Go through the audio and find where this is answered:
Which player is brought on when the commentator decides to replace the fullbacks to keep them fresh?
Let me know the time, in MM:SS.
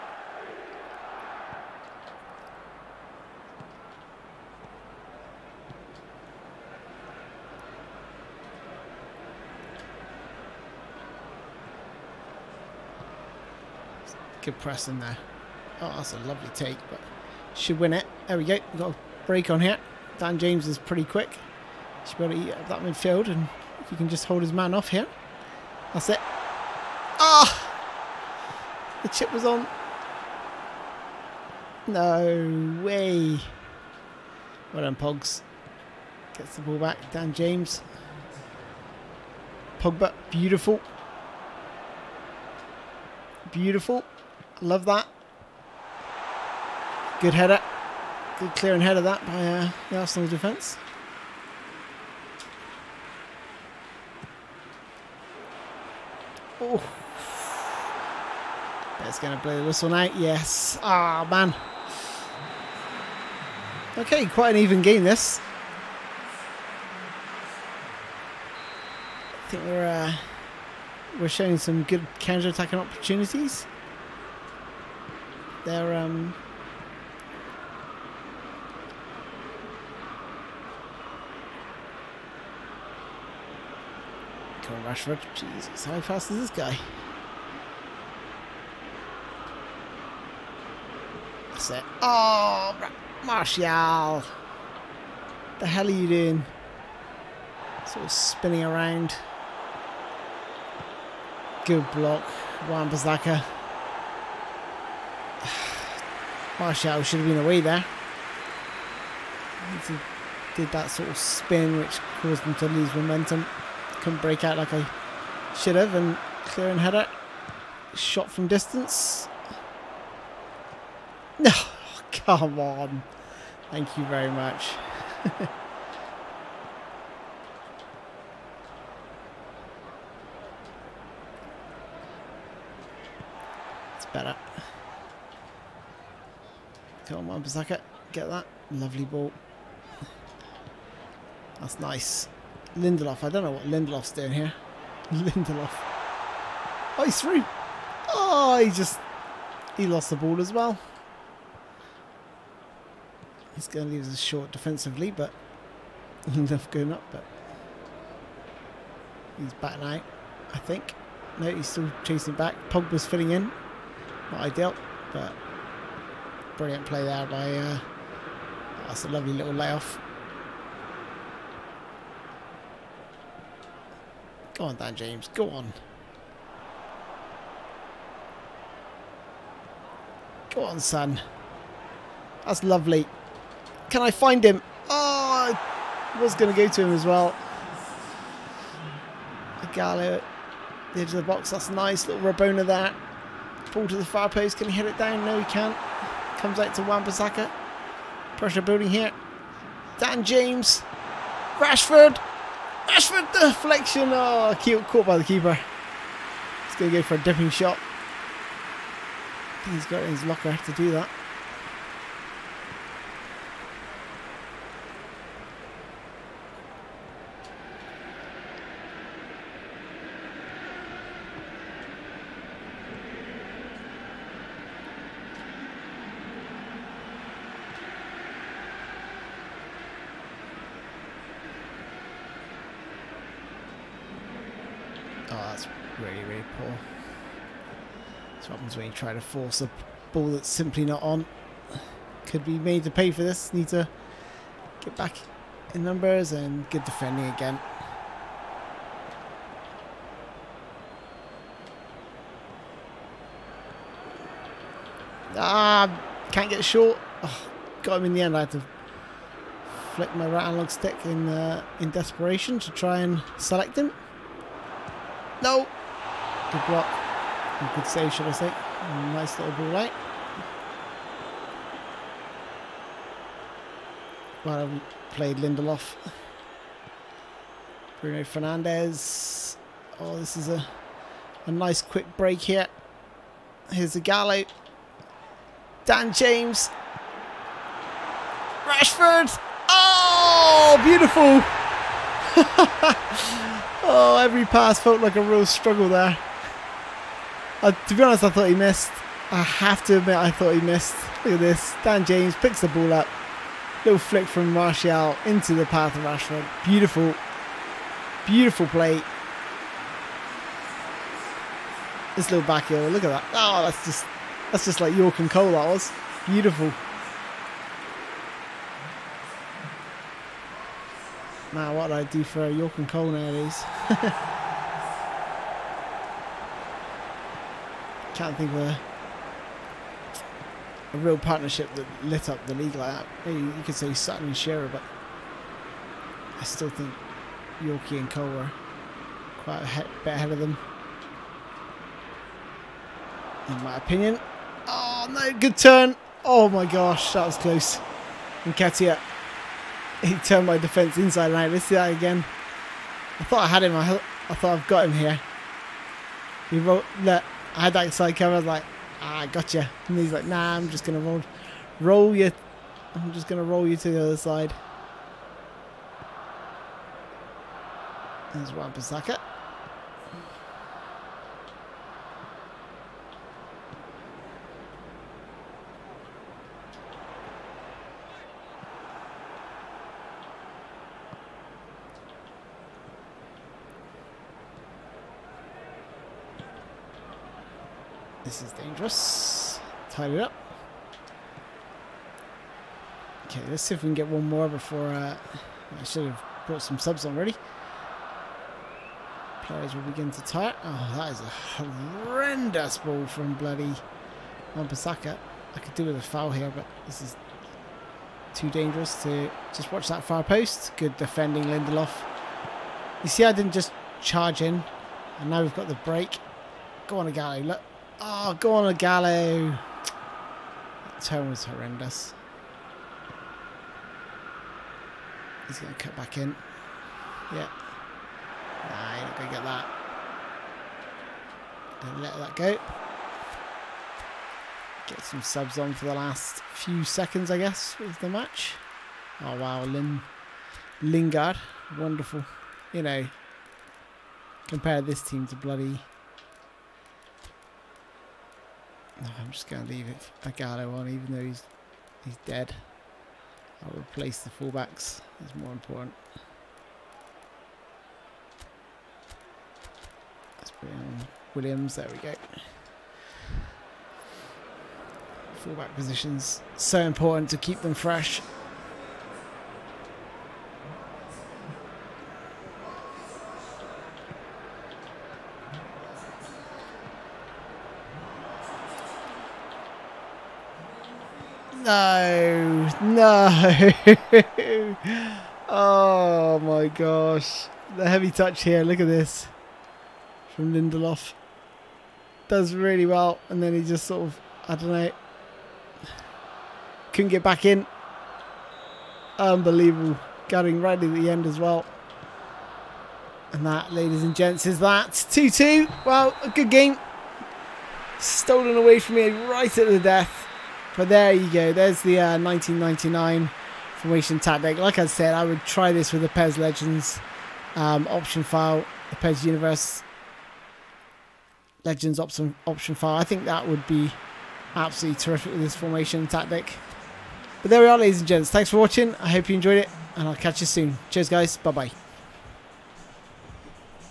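07:41.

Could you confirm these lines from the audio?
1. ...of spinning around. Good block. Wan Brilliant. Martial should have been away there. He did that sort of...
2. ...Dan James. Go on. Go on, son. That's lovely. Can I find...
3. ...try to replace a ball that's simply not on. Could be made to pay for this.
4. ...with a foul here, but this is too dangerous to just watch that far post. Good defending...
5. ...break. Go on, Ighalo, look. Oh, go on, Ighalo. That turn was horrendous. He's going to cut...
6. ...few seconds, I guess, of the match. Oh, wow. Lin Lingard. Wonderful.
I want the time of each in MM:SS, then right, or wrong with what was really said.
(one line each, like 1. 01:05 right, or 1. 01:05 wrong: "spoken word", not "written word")
1. 01:38 wrong: "Bissaka", not "Brilliant"
2. 02:54 right
3. 03:58 wrong: "force", not "replace"
4. 06:45 right
5. 06:55 right
6. 07:16 right.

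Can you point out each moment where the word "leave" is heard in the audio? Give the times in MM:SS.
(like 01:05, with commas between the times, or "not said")
02:33, 07:29.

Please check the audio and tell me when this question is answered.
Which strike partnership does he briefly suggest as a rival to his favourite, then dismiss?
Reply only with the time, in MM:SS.
05:33.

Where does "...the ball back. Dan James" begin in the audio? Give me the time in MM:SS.
00:36.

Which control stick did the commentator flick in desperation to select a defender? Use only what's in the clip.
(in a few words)
right analog stick.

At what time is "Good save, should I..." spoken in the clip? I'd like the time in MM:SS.
04:27.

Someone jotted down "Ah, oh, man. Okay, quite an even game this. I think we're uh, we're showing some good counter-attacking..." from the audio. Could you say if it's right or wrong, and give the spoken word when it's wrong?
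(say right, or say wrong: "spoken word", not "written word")
right.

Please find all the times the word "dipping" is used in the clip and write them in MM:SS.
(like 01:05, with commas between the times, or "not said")
03:27.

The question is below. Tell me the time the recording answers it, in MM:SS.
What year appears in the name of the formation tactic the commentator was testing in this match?
08:32.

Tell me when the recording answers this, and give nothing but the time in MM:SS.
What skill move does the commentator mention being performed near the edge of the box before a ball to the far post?
03:12.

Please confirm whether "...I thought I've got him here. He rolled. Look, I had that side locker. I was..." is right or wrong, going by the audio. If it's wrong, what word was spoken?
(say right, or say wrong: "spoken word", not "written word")
wrong: "cover", not "locker".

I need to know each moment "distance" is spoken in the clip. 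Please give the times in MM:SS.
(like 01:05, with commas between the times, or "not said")
01:58.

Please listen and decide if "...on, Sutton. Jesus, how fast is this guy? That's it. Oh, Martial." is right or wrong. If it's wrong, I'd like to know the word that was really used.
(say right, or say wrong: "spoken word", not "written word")
wrong: "Rashford", not "Sutton".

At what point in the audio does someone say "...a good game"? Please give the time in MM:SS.
08:26.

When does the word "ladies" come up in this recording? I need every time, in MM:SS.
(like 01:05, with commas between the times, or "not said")
08:23, 08:47.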